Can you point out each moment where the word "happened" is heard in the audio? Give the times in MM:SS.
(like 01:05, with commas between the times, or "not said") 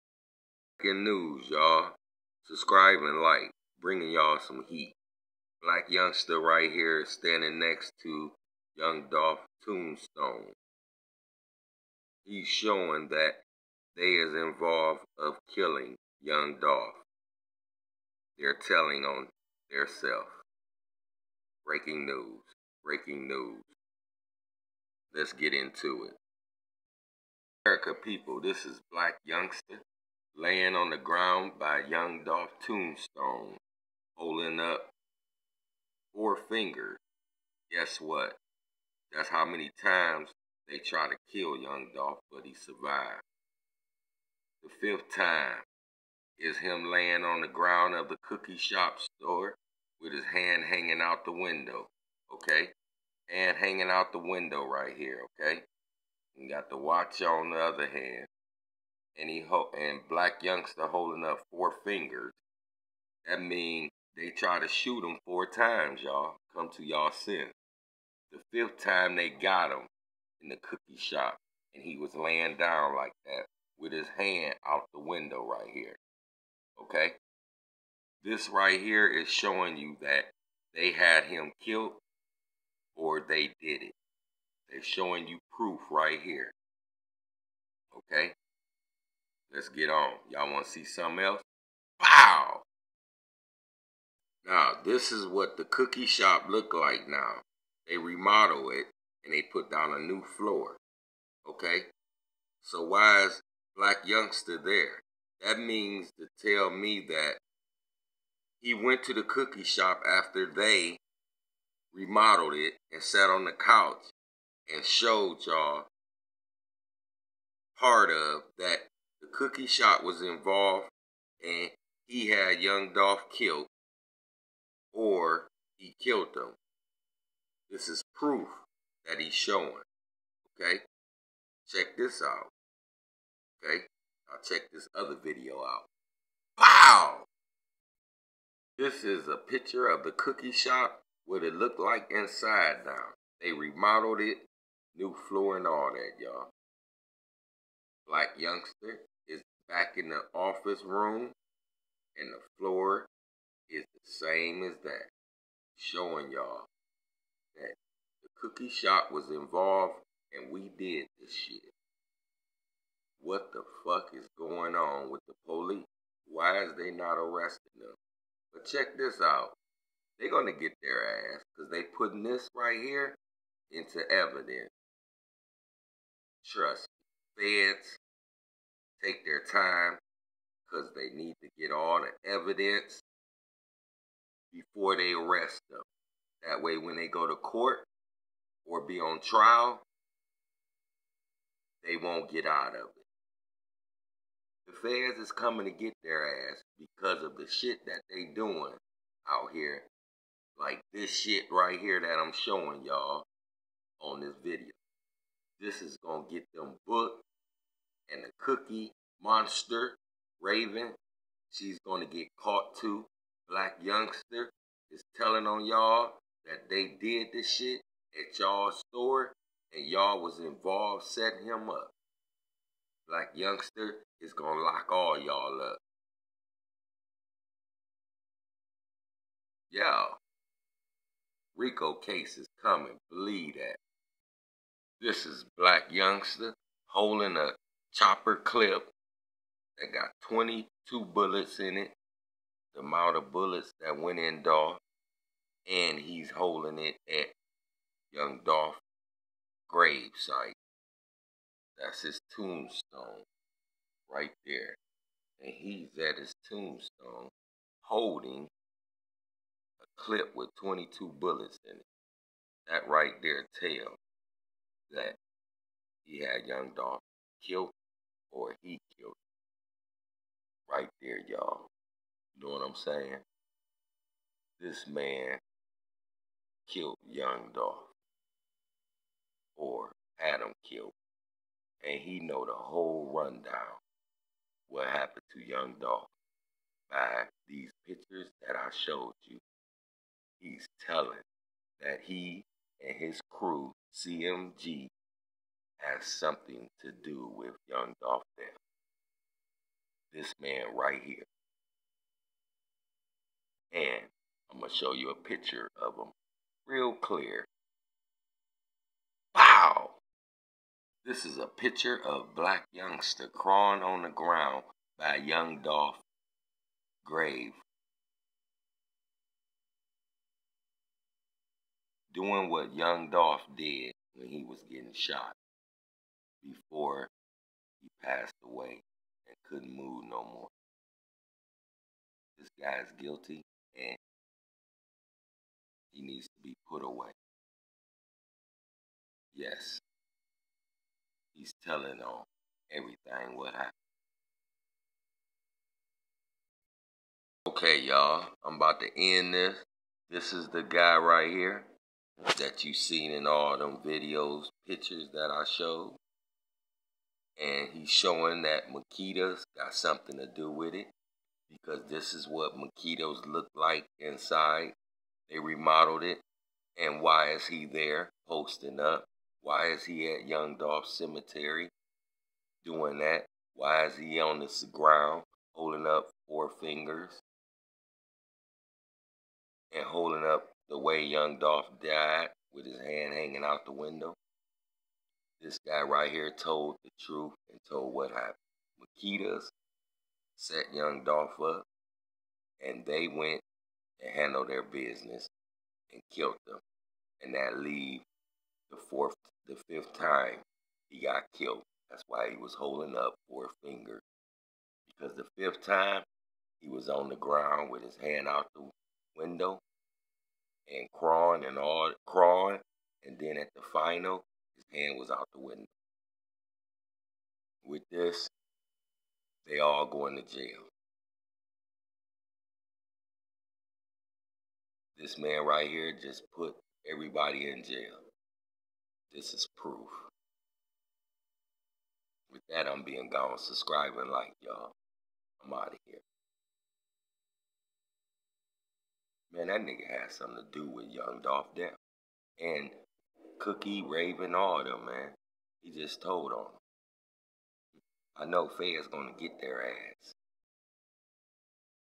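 04:44, 05:43, 06:28.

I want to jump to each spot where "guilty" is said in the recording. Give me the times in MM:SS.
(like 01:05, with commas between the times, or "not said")
05:32.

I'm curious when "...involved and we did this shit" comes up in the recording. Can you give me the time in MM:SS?
02:39.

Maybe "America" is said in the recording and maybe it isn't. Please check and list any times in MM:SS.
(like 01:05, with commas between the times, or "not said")
00:27.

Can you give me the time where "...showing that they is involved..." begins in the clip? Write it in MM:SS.
00:12.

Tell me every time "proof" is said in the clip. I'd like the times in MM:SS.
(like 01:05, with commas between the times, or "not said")
01:25, 02:08, 07:09.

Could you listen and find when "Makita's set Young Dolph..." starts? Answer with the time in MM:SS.
06:28.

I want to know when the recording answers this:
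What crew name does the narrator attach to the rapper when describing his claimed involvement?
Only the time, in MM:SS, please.
04:53.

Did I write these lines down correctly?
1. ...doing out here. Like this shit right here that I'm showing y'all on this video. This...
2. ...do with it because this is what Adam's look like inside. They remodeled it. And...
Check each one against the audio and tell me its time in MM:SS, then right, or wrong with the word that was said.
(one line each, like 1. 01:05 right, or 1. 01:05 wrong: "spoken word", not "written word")
1. 03:18 right
2. 06:00 wrong: "Makita", not "Adam".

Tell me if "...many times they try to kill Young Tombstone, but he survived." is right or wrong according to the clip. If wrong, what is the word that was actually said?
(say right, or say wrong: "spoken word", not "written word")
wrong: "Dolph", not "Tombstone".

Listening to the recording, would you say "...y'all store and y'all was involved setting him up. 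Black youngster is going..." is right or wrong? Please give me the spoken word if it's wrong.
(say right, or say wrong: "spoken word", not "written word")
right.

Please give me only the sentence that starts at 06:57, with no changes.
With this, they all going to jail.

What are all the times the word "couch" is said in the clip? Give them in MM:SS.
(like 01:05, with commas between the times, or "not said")
01:53.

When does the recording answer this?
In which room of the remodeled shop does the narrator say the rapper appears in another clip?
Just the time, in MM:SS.
02:30.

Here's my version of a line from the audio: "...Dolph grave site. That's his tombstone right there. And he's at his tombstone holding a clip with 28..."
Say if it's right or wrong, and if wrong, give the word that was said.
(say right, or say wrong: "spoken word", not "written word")
wrong: "22", not "28".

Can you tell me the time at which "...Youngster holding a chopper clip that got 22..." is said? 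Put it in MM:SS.
03:55.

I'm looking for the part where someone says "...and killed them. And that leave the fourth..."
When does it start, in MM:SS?
06:35.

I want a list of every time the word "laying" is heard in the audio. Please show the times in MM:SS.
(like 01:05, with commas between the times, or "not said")
00:30, 00:46, 01:12.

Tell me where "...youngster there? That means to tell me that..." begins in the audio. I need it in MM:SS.
01:44.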